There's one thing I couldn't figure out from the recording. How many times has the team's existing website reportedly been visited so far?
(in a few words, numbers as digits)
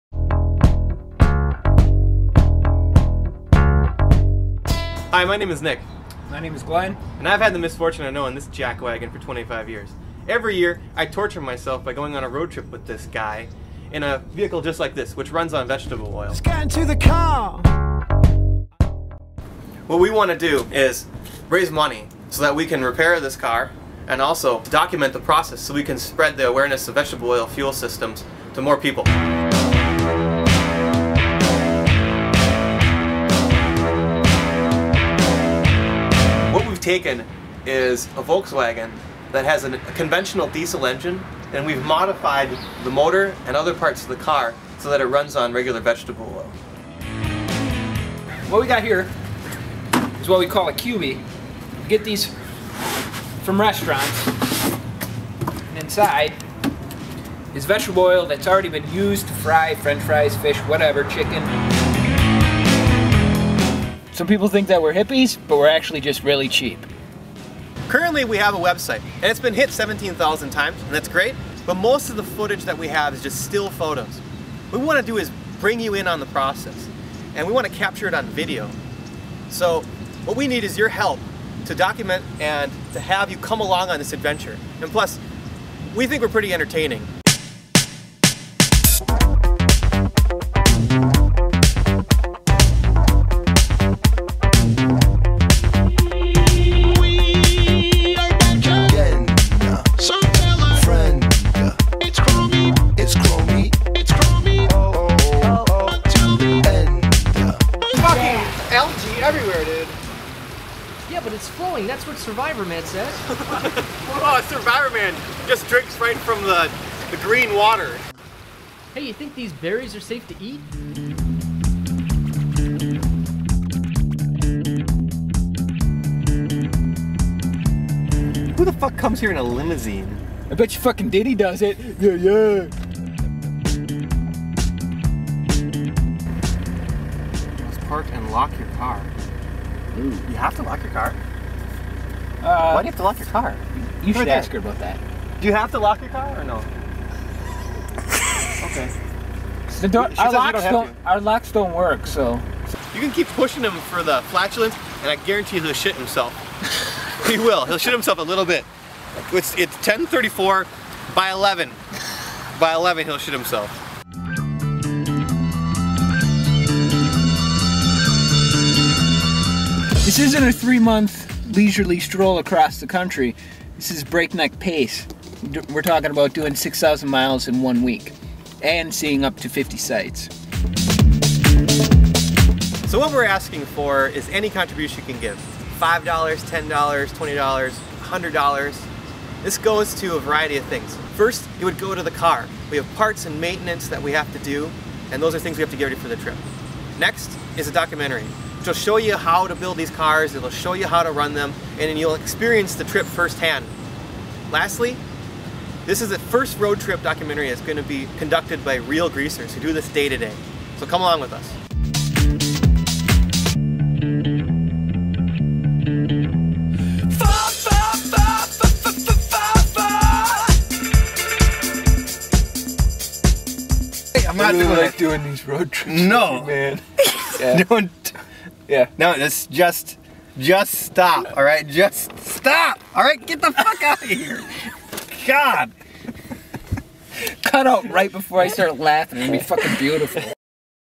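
17,000.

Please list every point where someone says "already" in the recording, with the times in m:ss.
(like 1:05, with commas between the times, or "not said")
0:58.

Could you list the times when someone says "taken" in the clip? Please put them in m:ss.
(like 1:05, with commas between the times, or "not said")
0:36.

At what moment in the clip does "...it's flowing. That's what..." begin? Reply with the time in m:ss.
1:51.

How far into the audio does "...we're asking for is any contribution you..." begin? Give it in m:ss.
3:03.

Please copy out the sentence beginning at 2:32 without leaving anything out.
You can keep pushing him for the flatulence, and I guarantee he'll shit himself.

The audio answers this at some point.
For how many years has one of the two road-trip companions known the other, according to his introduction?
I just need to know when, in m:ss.
0:09.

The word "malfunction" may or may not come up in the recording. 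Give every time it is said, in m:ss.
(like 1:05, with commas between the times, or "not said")
not said.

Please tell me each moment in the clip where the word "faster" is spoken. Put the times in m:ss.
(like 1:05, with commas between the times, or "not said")
not said.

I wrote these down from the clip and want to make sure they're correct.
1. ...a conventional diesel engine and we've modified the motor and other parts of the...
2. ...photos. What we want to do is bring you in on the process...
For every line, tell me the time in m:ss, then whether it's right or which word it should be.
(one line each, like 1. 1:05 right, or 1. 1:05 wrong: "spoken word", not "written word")
1. 0:39 right
2. 1:13 right.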